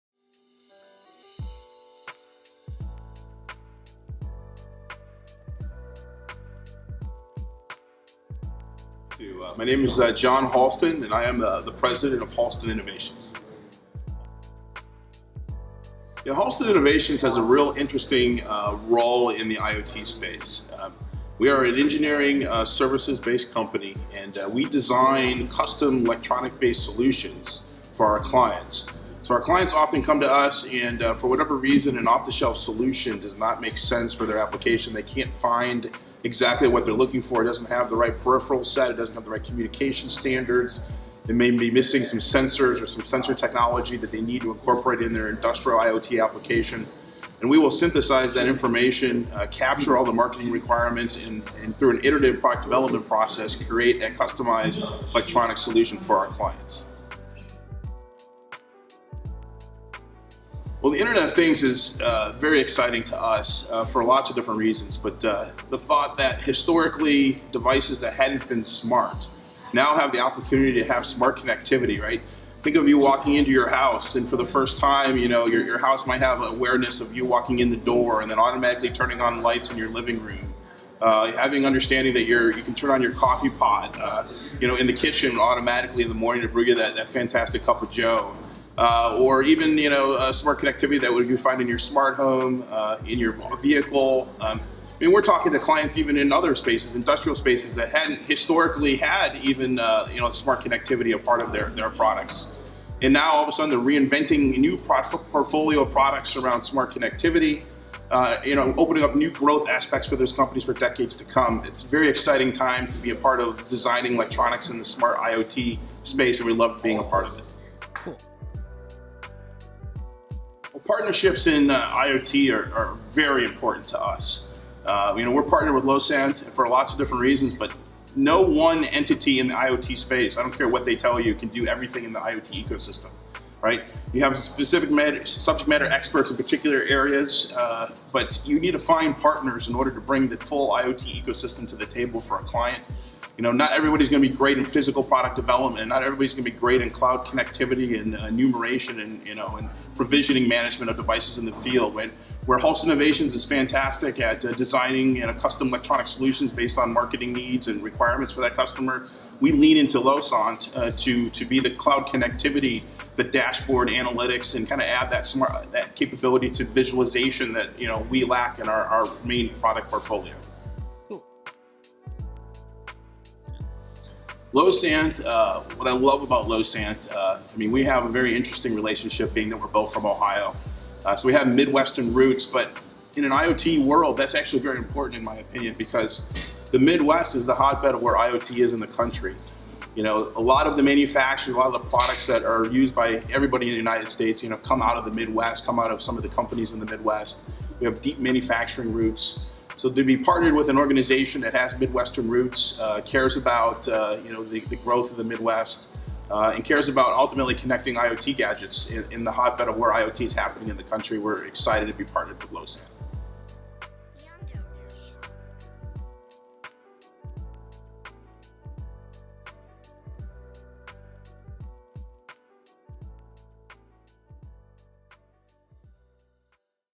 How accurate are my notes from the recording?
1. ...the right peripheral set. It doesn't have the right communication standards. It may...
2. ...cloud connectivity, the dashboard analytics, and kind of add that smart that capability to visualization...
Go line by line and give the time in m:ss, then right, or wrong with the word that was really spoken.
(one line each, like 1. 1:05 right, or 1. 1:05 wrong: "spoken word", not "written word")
1. 0:37 right
2. 2:41 right.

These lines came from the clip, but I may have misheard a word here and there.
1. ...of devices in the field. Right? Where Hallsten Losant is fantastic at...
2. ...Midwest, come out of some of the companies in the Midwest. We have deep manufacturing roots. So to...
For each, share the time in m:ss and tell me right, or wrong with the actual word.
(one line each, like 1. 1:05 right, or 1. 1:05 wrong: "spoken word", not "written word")
1. 2:30 wrong: "Innovations", not "Losant"
2. 3:15 right.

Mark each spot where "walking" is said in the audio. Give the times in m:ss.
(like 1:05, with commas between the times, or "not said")
1:12, 1:17.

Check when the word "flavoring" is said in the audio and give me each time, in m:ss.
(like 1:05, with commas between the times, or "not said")
not said.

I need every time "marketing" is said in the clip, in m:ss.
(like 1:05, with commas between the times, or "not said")
0:50, 2:36.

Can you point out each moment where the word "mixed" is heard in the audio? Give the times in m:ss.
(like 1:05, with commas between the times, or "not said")
not said.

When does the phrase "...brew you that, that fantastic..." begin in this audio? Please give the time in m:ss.
1:26.